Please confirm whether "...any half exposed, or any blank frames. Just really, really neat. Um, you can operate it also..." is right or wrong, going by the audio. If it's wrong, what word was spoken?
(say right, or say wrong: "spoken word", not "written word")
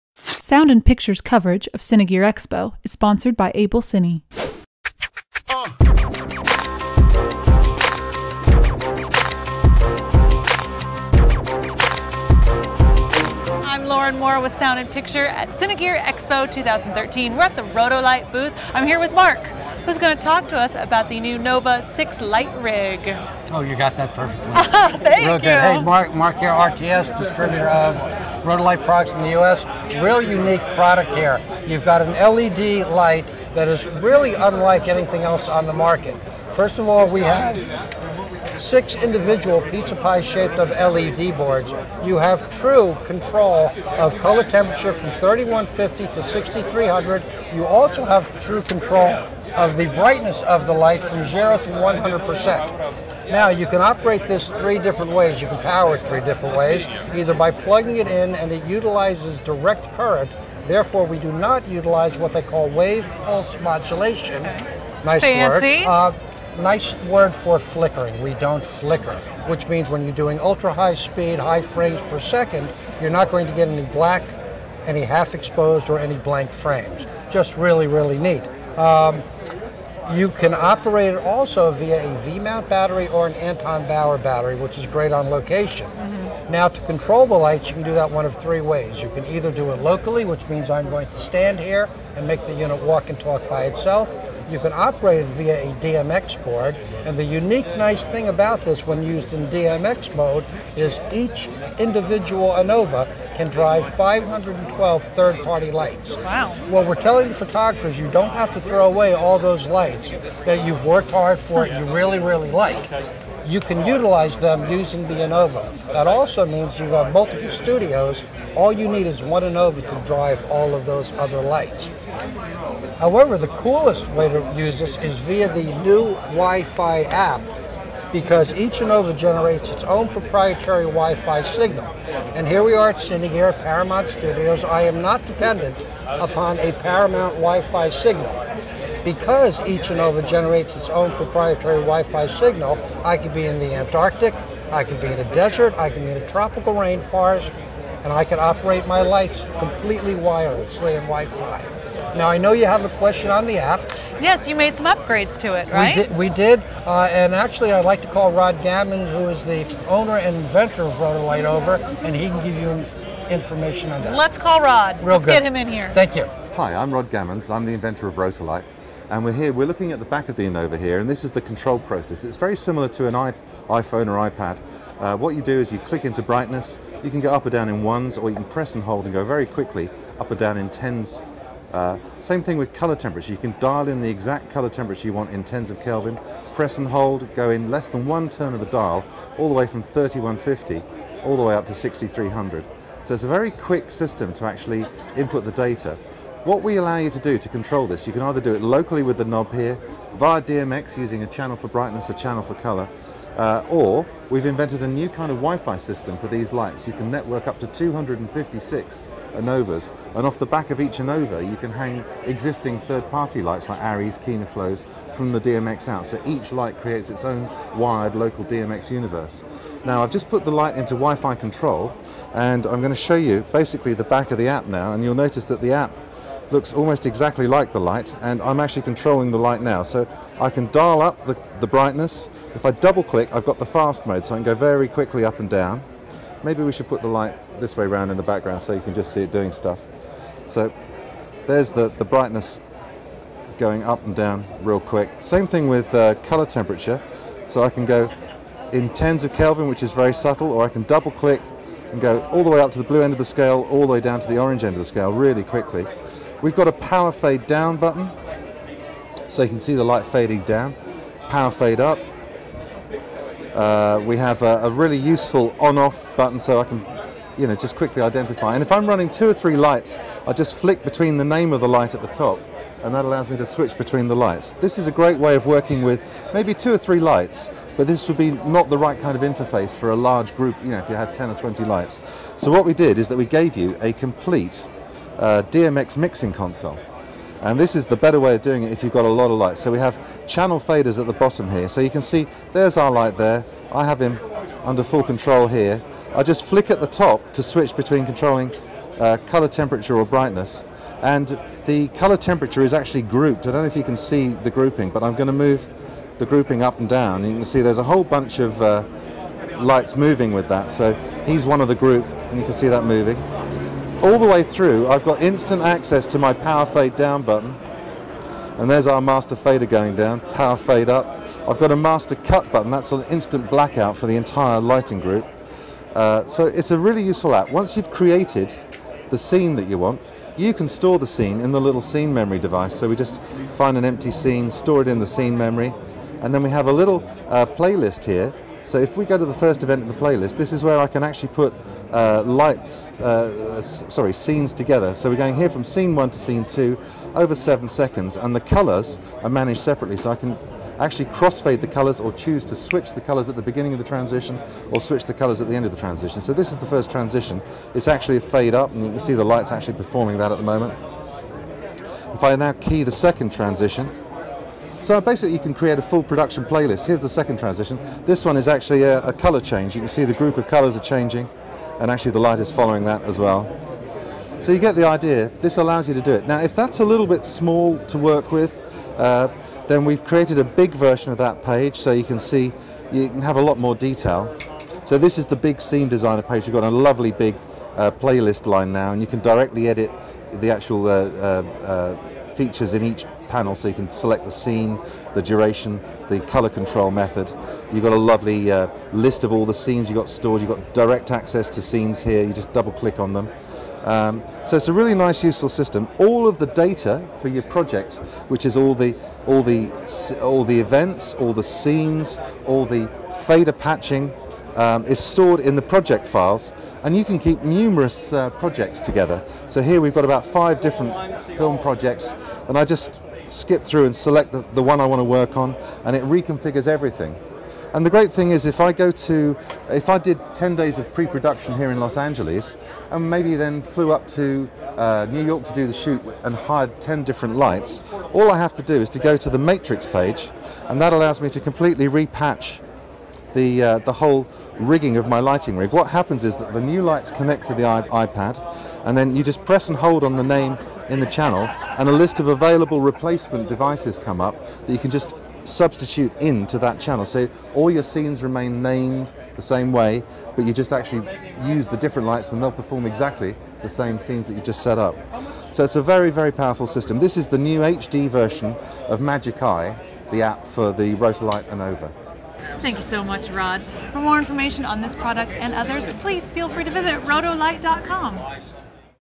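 right.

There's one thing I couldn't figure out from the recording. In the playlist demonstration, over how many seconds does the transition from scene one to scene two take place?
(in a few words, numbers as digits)
7.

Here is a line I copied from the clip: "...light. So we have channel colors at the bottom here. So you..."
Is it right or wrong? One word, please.
wrong.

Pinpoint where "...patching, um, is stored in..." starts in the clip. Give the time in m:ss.
6:53.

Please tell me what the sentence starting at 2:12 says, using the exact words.
And here we are at here at Paramount Studios.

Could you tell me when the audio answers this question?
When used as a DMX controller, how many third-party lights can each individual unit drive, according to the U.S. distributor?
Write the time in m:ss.
1:43.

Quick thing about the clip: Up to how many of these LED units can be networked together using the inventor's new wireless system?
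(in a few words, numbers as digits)
256.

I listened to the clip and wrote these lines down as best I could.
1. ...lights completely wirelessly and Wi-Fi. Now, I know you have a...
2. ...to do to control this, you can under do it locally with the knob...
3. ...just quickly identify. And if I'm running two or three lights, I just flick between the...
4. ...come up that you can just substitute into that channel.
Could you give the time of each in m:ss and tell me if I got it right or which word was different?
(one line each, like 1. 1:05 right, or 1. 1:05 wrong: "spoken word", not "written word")
1. 2:29 right
2. 3:17 wrong: "either", not "under"
3. 4:27 right
4. 7:33 right.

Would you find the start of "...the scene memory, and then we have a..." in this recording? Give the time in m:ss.
5:34.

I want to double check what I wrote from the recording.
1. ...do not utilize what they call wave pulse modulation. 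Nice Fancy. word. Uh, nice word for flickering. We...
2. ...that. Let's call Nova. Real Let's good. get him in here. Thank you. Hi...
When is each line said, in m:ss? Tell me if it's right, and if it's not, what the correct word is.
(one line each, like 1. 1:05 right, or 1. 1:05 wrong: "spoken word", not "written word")
1. 1:01 right
2. 2:44 wrong: "Rod", not "Nova".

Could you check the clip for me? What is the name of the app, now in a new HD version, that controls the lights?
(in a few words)
Magic Eye.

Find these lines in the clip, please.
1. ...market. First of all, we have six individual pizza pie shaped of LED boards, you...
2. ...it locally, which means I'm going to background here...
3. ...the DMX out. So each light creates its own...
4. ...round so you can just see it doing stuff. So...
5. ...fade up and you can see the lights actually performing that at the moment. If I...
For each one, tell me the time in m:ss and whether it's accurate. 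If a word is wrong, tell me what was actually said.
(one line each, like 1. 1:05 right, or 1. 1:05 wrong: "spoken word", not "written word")
1. 0:35 right
2. 1:29 wrong: "stand", not "background"
3. 3:35 right
4. 3:58 wrong: "background", not "round"
5. 5:58 right.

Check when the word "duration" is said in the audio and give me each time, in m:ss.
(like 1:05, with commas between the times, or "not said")
6:35.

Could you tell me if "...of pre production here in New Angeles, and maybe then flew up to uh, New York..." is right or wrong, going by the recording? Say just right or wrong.
wrong.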